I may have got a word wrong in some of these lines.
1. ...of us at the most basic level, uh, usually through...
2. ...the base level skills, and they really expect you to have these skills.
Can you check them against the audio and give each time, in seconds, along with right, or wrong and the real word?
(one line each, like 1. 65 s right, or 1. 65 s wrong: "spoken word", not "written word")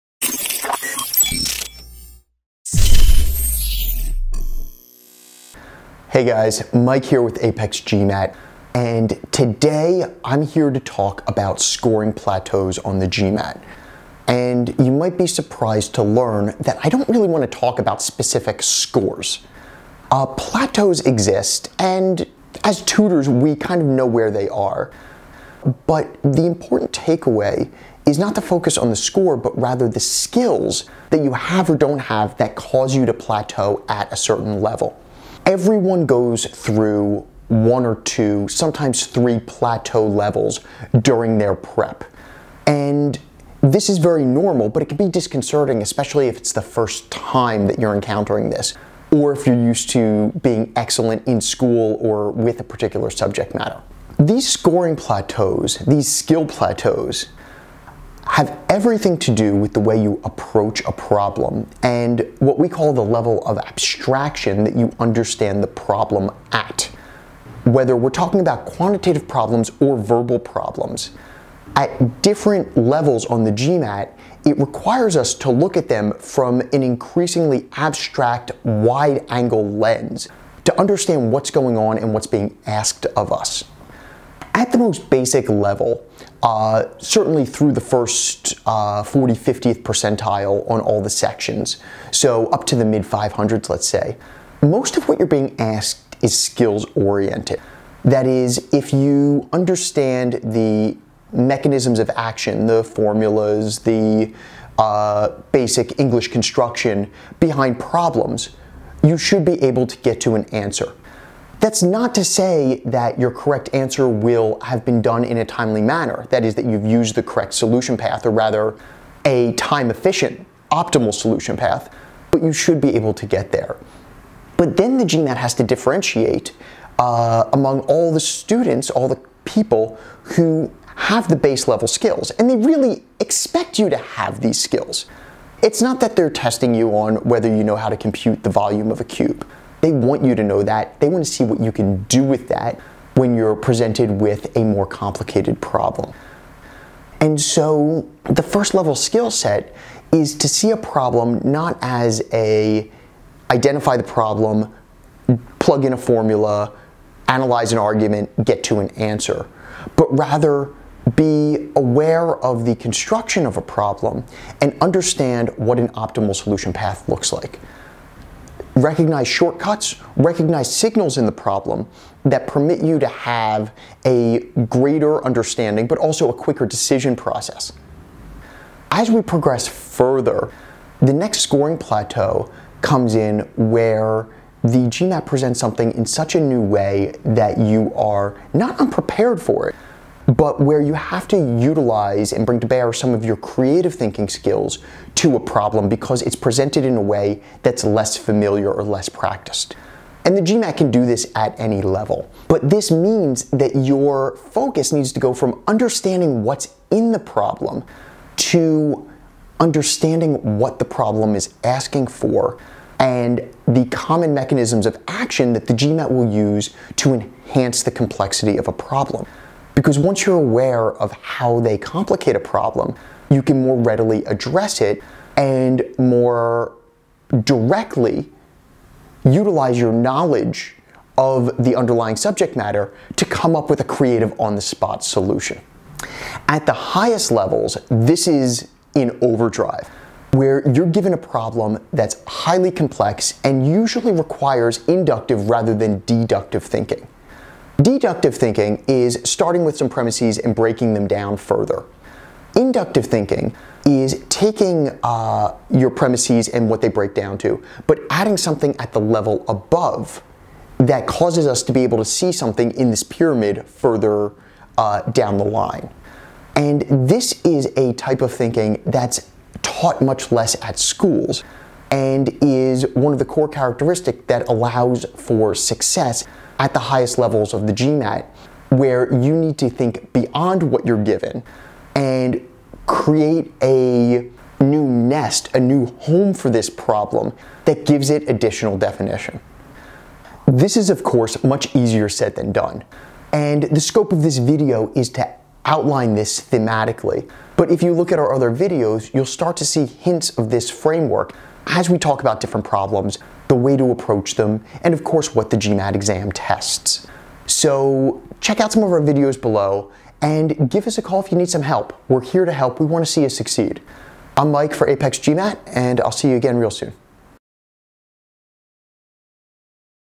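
1. 83 s wrong: "certainly", not "usually"
2. 131 s right.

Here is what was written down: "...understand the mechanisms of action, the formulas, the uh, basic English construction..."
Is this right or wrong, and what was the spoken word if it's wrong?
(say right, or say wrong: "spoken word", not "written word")
right.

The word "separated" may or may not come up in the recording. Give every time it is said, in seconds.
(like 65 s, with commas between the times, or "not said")
not said.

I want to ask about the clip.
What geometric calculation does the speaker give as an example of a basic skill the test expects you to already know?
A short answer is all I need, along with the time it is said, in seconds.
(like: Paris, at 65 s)
volume of a cube, at 138 s.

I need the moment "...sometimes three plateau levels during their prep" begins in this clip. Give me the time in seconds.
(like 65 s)
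38 s.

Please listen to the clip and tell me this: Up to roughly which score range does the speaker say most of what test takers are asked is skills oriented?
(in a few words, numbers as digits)
mid 500s.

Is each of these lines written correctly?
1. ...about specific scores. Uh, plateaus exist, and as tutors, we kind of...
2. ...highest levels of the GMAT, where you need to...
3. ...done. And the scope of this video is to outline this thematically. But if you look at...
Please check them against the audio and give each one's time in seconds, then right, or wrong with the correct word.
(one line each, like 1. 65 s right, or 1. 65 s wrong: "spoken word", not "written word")
1. 17 s right
2. 276 s right
3. 292 s right.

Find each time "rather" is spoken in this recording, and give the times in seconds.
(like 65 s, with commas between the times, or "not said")
29 s, 118 s, 160 s, 245 s.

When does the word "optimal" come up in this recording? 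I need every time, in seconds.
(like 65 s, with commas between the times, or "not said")
120 s, 165 s.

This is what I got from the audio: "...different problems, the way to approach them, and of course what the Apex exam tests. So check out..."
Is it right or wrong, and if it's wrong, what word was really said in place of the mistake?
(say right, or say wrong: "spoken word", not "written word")
wrong: "GMAT", not "Apex".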